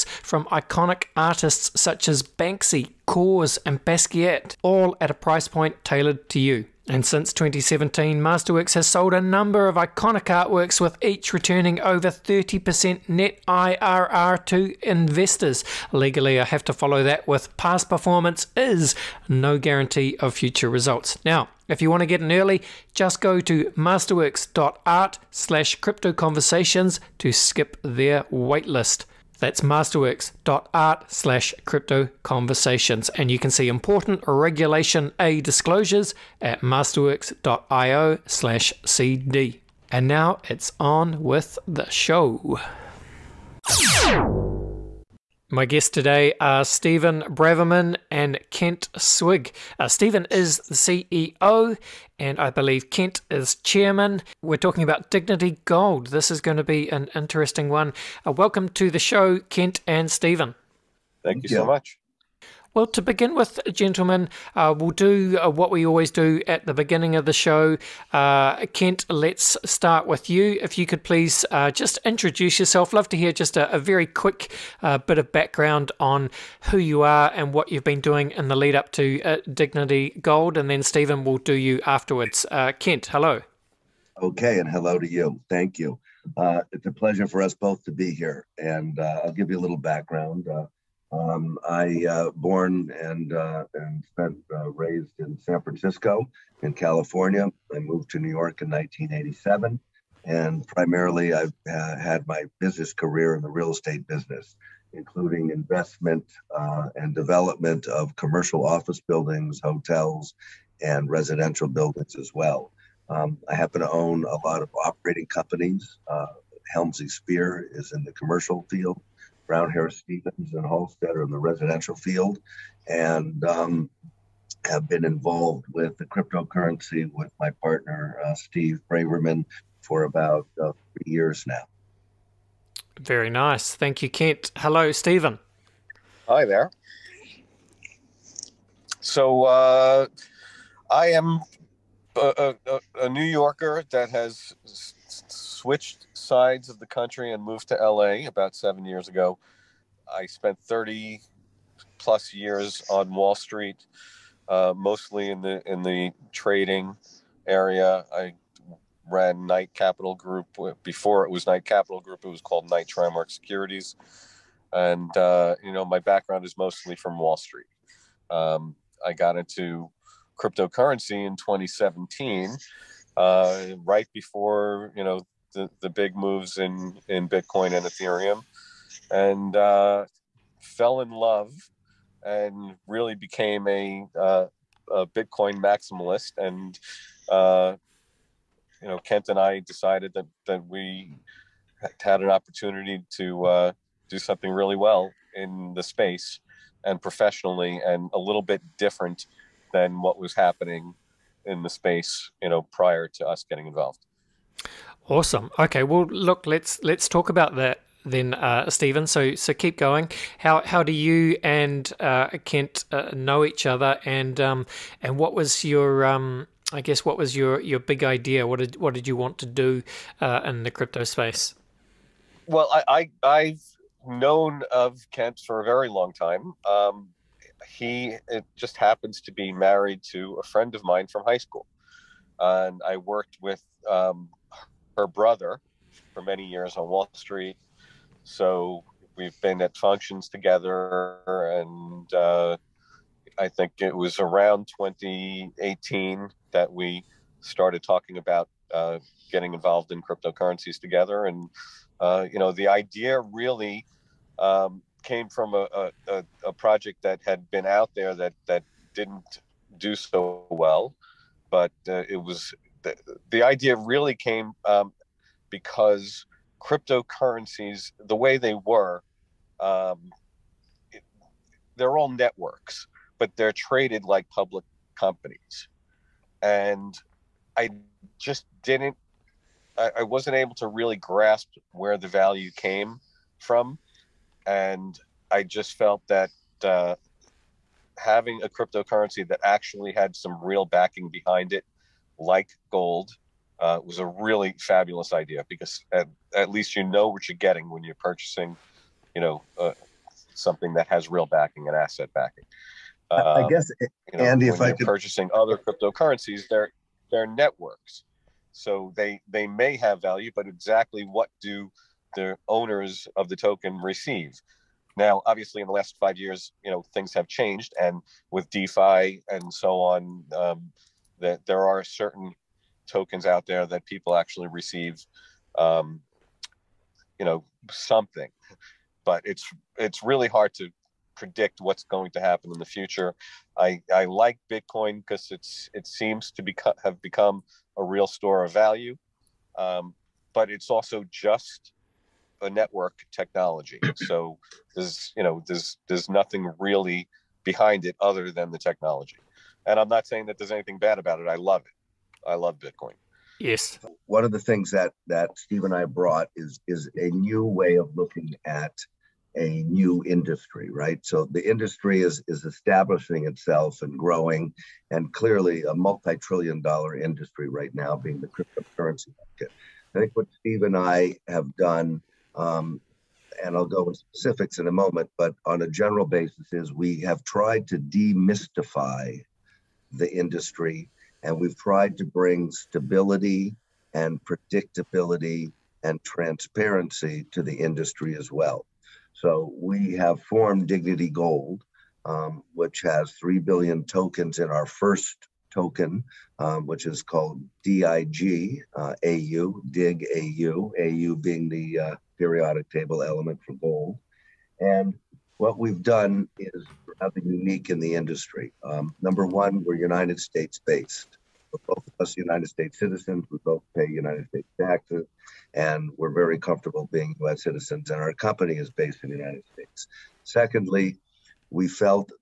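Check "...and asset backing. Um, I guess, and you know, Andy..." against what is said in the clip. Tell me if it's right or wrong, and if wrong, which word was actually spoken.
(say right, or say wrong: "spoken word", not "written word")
right.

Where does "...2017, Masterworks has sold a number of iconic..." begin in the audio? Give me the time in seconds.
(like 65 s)
7 s.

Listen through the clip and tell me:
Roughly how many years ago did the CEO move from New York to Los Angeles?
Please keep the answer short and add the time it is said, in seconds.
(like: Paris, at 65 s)
7, at 148 s.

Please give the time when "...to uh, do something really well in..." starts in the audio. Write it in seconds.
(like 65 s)
193 s.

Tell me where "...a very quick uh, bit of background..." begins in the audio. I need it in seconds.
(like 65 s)
73 s.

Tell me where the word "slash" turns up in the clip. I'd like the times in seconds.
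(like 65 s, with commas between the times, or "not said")
25 s, 31 s, 38 s.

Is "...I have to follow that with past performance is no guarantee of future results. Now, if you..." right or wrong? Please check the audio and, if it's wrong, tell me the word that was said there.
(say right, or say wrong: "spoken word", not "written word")
right.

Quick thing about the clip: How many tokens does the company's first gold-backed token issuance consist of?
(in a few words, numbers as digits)
3 billion.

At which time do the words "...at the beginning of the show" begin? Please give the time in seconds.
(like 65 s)
66 s.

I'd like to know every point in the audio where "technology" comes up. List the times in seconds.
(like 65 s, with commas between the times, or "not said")
343 s, 348 s.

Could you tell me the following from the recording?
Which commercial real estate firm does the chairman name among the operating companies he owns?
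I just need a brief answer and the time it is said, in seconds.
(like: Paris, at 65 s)
Helmsley Spear, at 116 s.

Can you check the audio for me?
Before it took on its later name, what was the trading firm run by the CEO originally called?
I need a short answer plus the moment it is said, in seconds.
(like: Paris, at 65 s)
Knight Trimark Securities, at 162 s.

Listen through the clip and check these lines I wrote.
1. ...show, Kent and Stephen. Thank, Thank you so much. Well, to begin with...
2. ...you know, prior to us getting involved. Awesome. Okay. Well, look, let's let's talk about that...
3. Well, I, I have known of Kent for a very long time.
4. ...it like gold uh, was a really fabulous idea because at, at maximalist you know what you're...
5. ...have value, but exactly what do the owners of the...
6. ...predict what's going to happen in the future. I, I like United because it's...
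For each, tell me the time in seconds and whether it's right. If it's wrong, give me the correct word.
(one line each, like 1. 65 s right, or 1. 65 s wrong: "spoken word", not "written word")
1. 58 s right
2. 202 s right
3. 222 s right
4. 291 s wrong: "least", not "maximalist"
5. 309 s right
6. 331 s wrong: "Bitcoin", not "United".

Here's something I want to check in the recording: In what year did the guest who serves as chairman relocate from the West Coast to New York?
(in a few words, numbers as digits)
1987.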